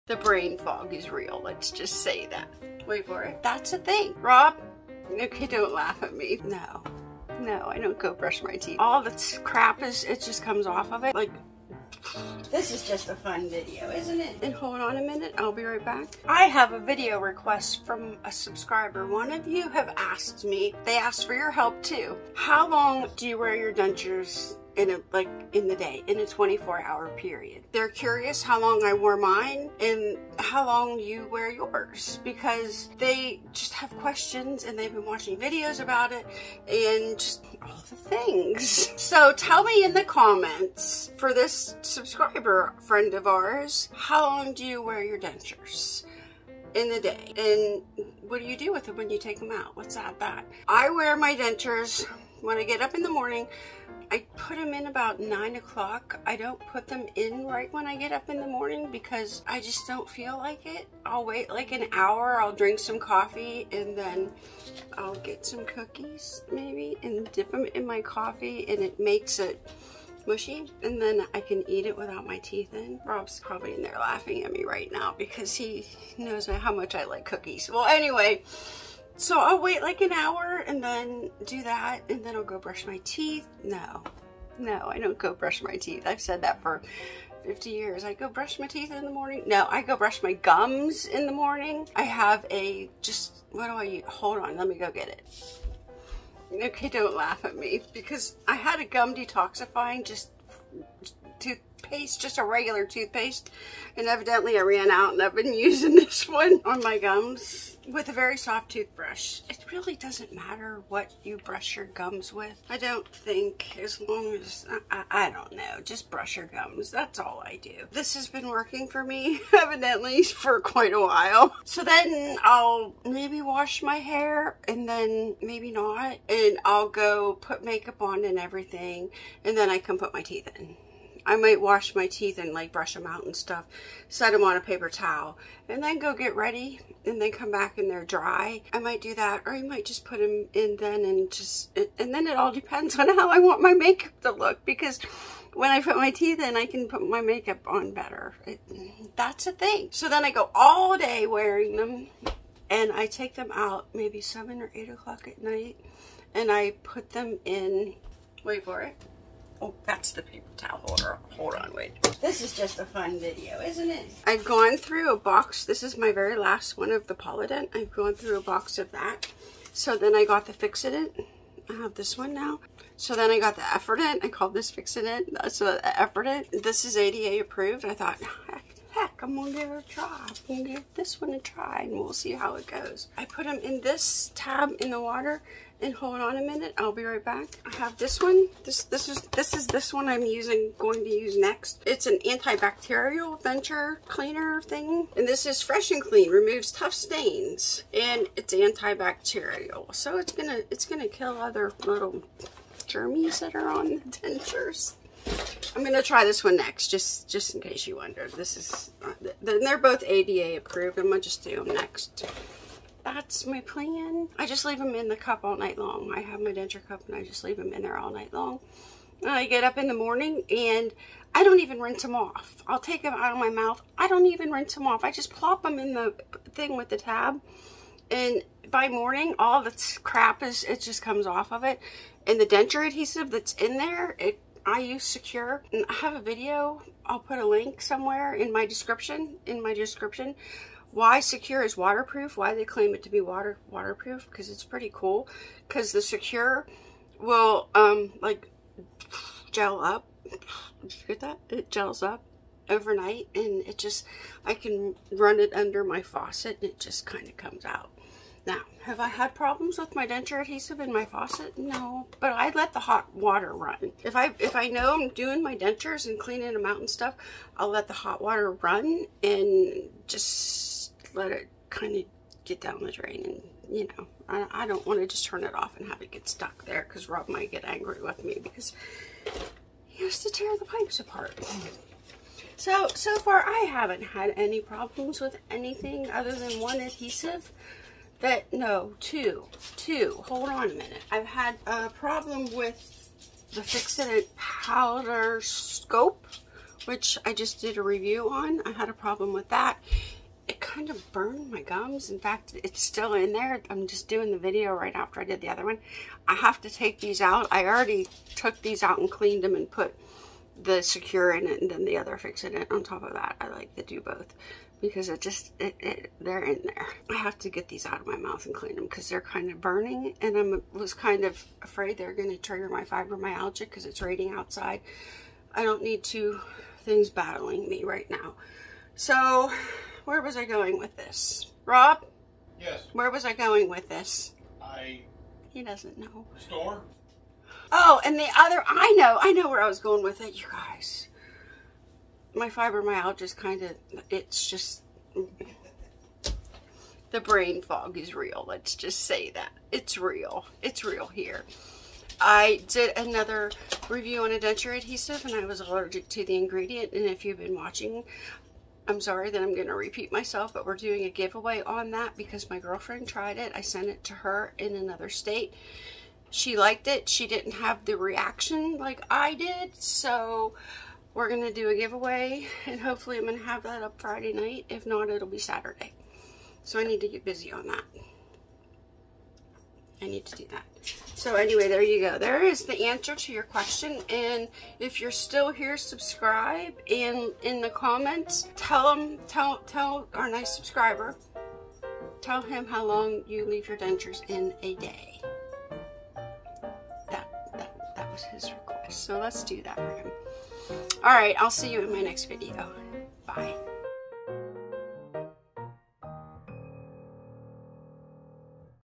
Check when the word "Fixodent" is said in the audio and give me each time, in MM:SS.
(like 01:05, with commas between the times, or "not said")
02:50, 02:54, 04:53, 05:12.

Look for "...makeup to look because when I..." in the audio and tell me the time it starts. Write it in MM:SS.
02:23.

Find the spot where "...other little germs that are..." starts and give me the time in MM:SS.
03:21.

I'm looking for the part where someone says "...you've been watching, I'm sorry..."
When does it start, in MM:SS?
05:57.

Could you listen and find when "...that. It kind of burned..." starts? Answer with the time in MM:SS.
04:59.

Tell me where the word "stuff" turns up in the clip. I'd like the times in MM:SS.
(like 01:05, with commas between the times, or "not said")
02:13, 04:26.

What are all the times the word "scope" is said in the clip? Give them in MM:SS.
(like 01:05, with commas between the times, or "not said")
04:55.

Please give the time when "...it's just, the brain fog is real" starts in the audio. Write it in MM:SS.
05:44.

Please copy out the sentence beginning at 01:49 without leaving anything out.
It really doesn't matter what you brush your gums with.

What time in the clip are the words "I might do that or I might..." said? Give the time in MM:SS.
02:18.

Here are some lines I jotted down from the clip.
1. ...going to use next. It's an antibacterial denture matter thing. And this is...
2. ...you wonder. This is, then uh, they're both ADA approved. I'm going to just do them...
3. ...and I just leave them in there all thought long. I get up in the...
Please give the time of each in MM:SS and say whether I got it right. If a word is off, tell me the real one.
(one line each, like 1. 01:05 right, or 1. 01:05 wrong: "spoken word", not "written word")
1. 03:10 wrong: "cleaner", not "matter"
2. 03:27 right
3. 03:37 wrong: "night", not "thought".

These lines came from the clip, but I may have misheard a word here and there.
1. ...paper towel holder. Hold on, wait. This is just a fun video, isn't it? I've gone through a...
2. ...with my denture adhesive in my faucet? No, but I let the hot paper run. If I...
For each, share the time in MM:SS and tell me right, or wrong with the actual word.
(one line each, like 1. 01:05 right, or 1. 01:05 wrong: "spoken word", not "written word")
1. 02:40 right
2. 04:19 wrong: "water", not "paper".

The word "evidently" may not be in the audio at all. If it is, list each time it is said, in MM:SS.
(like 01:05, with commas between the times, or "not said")
01:44, 01:59.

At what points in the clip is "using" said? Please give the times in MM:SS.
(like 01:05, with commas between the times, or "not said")
01:45, 03:10.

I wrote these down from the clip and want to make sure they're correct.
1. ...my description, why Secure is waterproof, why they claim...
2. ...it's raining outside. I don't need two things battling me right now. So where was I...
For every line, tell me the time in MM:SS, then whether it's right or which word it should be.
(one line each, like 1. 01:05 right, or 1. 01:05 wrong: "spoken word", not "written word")
1. 03:59 right
2. 05:23 right.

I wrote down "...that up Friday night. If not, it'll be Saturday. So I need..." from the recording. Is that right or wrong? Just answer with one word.
right.